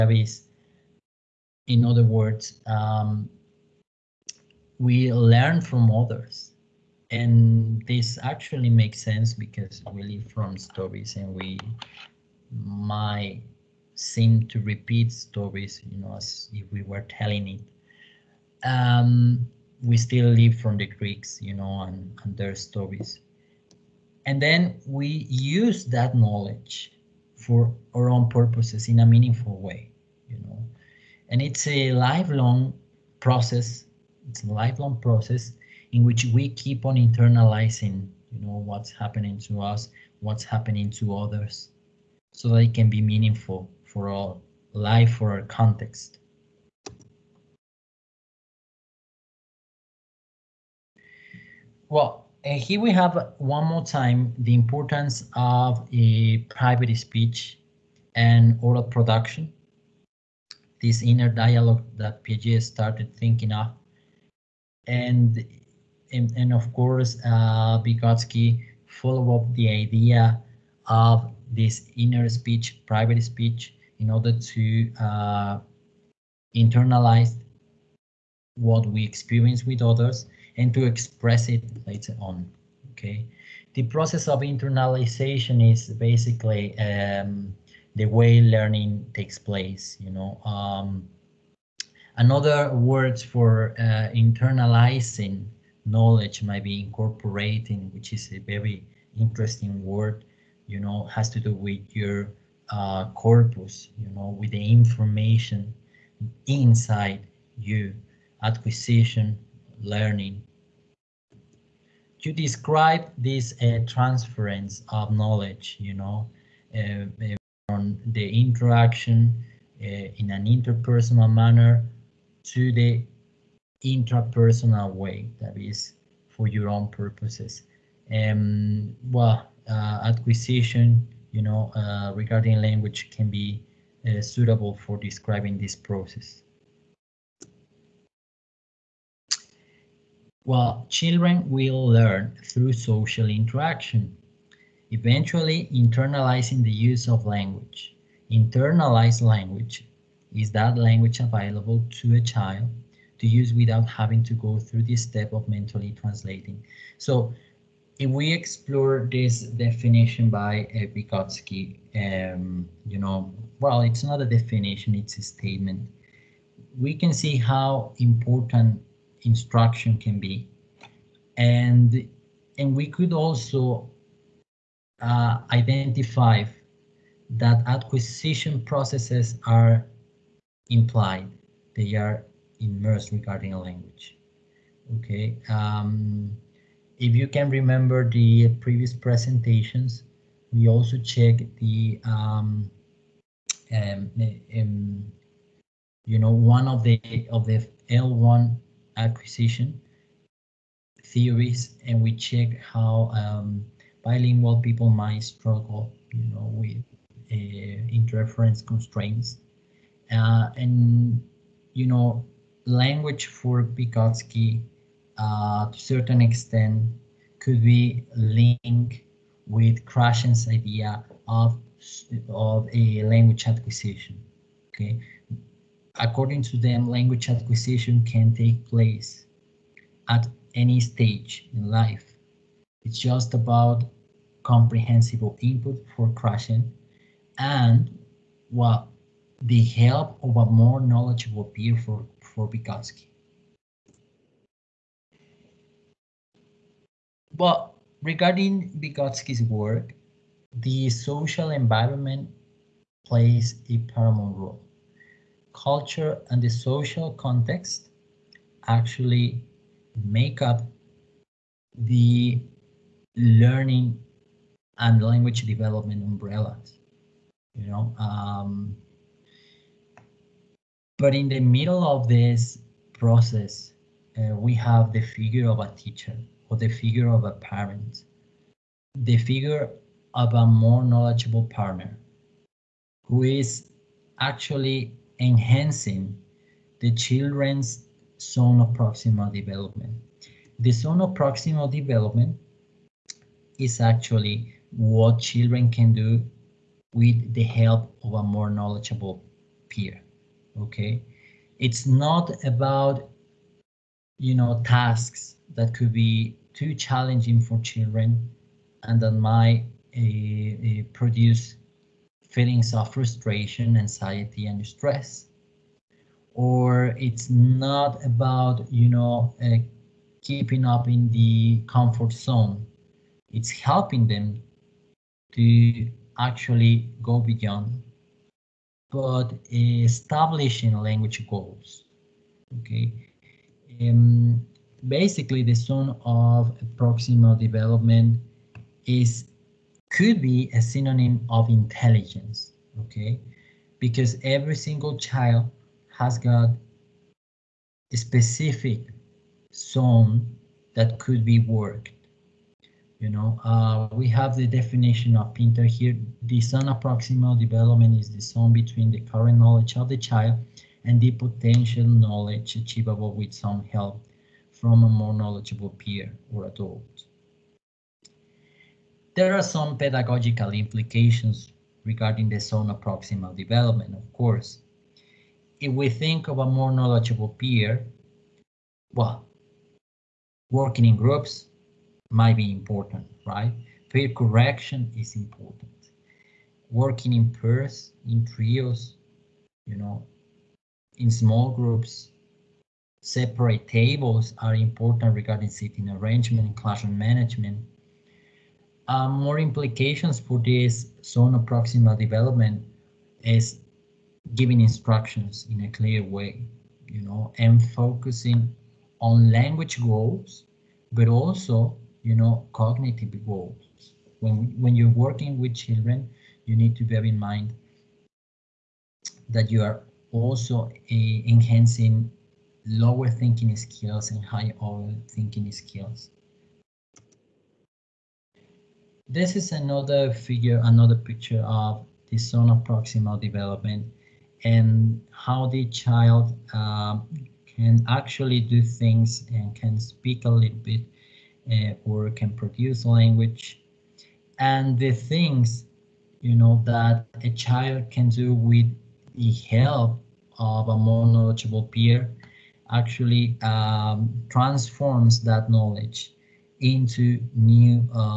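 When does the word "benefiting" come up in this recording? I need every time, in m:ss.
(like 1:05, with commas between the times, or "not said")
not said.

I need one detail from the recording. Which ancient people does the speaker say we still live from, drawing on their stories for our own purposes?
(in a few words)
The Greeks.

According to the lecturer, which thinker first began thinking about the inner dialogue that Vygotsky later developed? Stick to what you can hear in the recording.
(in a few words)
Piaget.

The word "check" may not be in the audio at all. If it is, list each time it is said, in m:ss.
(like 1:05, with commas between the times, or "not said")
3:10, 3:22.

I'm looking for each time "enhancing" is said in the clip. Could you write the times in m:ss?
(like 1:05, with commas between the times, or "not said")
4:45, 7:01.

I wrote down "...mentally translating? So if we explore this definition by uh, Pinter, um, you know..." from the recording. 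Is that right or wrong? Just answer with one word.
wrong.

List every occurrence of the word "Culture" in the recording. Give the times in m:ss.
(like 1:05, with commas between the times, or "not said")
4:15.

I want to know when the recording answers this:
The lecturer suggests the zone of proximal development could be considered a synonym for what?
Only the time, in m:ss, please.
5:41.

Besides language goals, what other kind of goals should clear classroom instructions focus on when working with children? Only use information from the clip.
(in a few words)
Cognitive goals.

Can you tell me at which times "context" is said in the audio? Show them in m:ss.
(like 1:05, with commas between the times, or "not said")
0:45, 4:17.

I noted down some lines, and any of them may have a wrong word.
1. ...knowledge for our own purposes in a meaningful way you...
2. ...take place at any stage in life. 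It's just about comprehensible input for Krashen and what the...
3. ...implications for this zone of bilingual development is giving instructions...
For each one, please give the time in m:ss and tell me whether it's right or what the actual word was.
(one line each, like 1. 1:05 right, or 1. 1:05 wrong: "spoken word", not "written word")
1. 0:26 right
2. 3:48 right
3. 6:39 wrong: "proximal", not "bilingual".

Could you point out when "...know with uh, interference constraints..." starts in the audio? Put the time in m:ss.
3:26.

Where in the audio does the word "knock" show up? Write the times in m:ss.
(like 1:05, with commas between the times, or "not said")
not said.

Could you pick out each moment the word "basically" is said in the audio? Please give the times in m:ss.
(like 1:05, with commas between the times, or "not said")
1:25, 5:34.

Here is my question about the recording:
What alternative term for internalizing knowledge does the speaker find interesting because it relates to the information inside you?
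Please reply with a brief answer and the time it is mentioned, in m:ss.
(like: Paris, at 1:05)
Incorporating, at 1:36.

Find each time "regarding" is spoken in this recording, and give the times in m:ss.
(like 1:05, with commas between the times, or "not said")
2:12, 3:03, 4:08, 6:11, 6:35.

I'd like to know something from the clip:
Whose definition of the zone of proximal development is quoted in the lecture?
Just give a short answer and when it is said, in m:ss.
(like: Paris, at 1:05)
Pinter, at 5:55.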